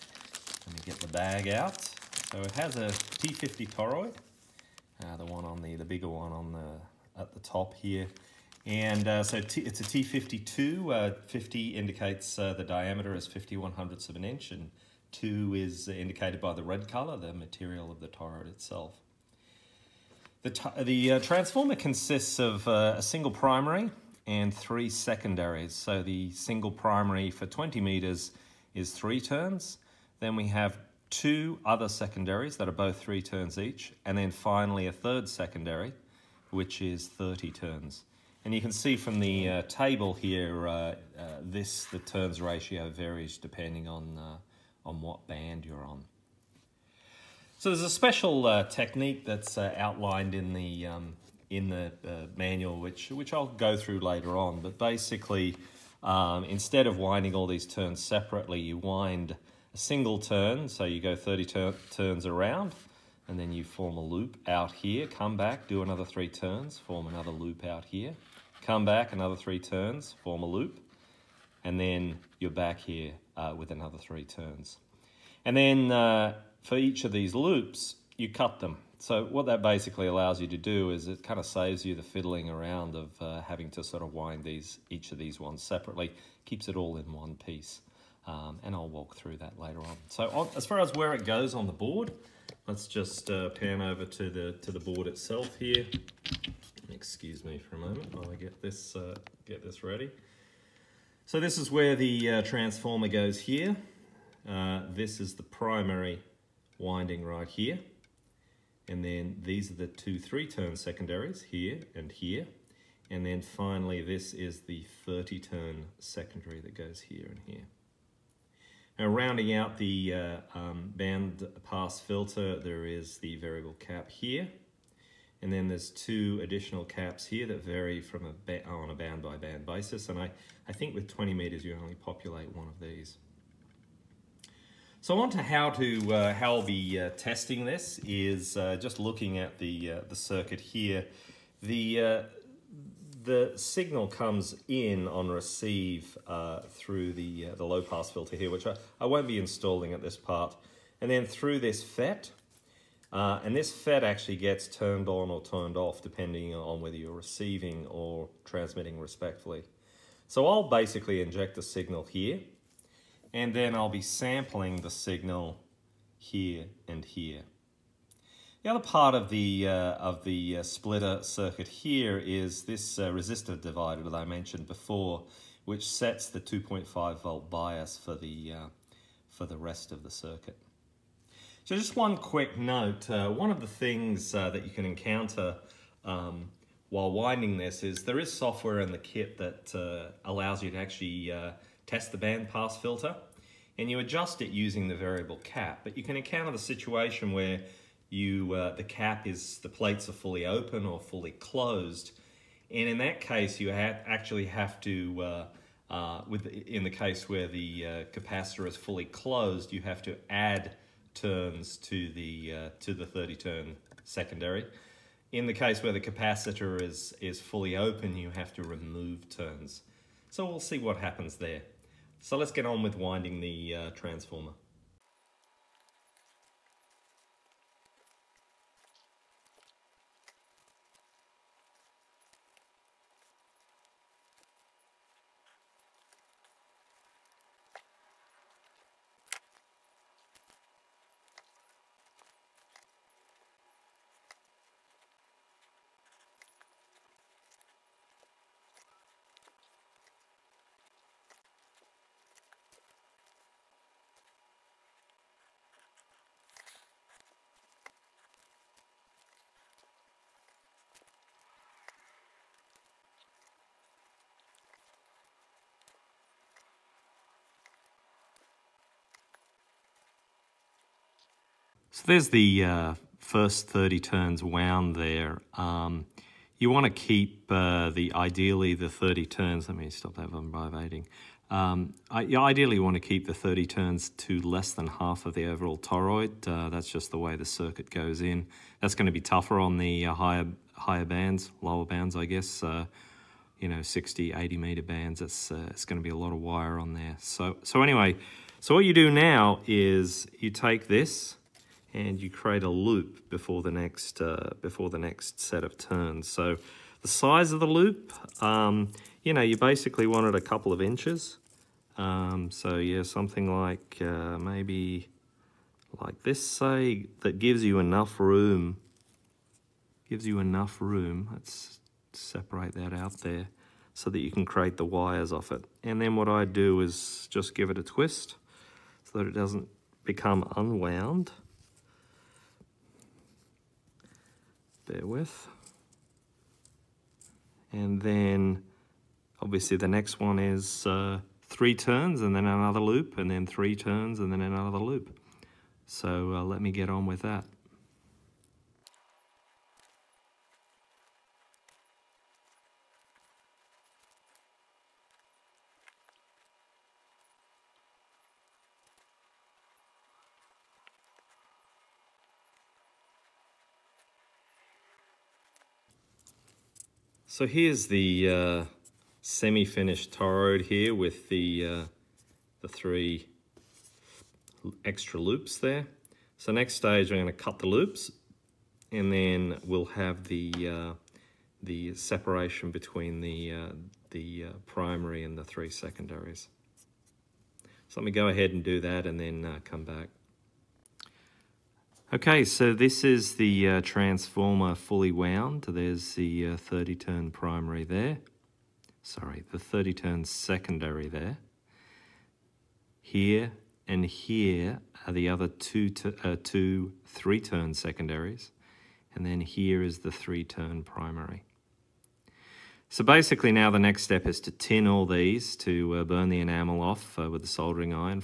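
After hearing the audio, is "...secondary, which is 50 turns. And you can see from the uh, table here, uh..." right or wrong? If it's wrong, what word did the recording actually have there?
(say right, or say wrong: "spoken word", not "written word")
wrong: "30", not "50".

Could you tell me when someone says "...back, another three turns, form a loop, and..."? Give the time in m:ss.
1:08.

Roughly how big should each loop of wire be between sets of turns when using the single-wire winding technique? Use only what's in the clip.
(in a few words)
A couple of inches.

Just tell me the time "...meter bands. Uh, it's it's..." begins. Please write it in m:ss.
4:54.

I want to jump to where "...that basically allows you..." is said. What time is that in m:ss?
1:19.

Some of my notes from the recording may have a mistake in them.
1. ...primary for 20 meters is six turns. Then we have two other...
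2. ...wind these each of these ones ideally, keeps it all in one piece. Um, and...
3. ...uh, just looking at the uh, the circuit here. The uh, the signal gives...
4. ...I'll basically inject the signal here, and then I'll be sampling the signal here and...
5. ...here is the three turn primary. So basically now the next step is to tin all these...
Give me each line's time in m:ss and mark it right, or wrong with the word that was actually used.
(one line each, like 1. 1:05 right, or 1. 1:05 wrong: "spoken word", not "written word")
1. 0:26 wrong: "three", not "six"
2. 1:24 wrong: "separately", not "ideally"
3. 2:18 wrong: "comes", not "gives"
4. 2:40 right
5. 6:49 right.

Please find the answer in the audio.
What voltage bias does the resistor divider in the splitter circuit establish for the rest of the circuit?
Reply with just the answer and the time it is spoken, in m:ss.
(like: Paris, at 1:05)
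2.5 volts, at 2:56.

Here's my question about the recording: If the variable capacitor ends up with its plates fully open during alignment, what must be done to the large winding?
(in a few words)
Remove turns.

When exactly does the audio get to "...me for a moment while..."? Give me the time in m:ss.
1:37.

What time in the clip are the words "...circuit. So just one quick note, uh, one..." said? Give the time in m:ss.
3:00.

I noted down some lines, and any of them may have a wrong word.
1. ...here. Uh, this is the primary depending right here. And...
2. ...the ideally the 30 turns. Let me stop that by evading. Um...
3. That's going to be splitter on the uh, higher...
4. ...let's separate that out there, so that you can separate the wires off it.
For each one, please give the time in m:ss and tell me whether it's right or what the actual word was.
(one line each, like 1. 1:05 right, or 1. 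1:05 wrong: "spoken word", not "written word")
1. 1:43 wrong: "winding", not "depending"
2. 4:37 right
3. 4:48 wrong: "tougher", not "splitter"
4. 5:21 wrong: "create", not "separate".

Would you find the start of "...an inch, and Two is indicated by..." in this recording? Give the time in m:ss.
0:14.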